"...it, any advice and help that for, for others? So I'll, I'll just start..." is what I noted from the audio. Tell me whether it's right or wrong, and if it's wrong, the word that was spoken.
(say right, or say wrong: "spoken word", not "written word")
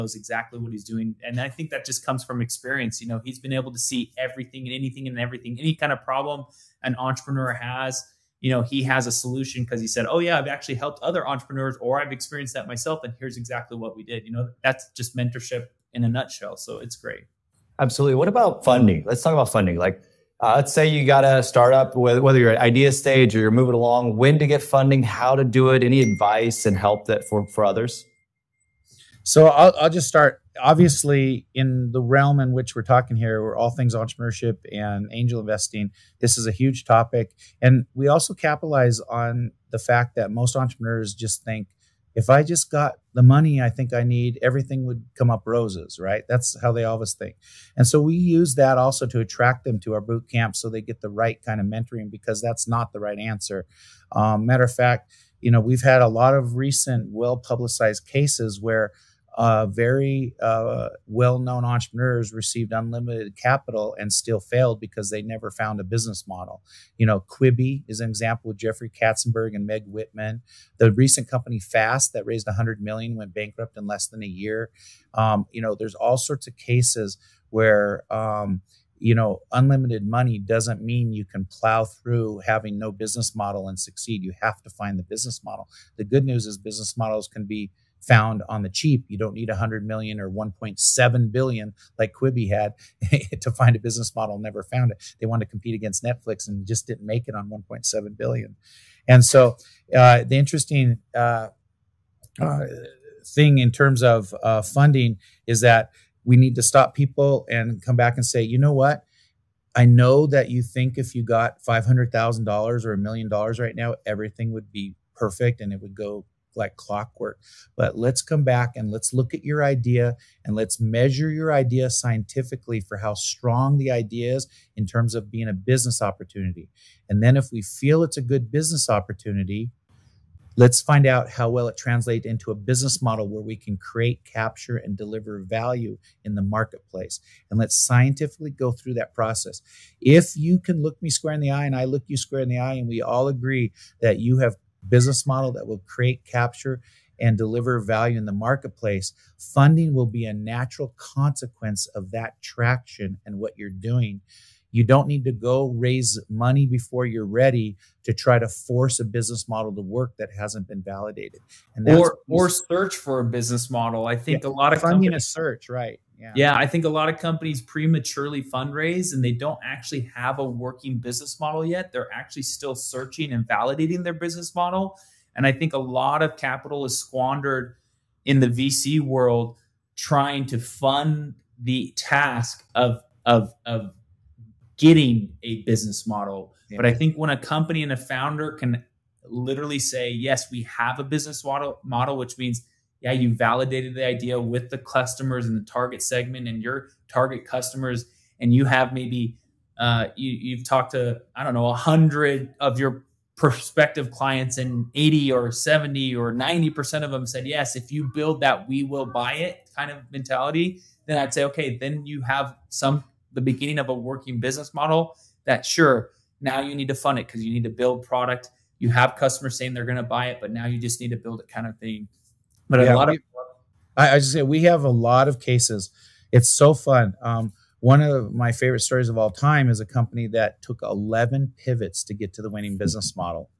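right.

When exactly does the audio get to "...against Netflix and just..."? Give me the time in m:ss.
1:35.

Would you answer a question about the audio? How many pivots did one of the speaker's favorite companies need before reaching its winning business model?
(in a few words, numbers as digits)
11.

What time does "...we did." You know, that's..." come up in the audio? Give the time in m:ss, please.
0:13.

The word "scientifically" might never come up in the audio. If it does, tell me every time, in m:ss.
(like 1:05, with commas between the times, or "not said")
2:01, 2:17.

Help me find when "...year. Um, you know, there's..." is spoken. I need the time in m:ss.
1:14.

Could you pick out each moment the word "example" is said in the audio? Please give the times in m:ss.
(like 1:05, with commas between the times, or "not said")
1:08.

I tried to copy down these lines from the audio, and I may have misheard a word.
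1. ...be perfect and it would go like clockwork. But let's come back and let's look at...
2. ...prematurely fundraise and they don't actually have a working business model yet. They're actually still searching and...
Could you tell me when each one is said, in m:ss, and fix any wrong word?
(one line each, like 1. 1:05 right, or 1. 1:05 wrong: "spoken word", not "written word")
1. 1:54 right
2. 2:47 right.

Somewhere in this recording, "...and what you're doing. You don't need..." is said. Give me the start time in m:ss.
2:33.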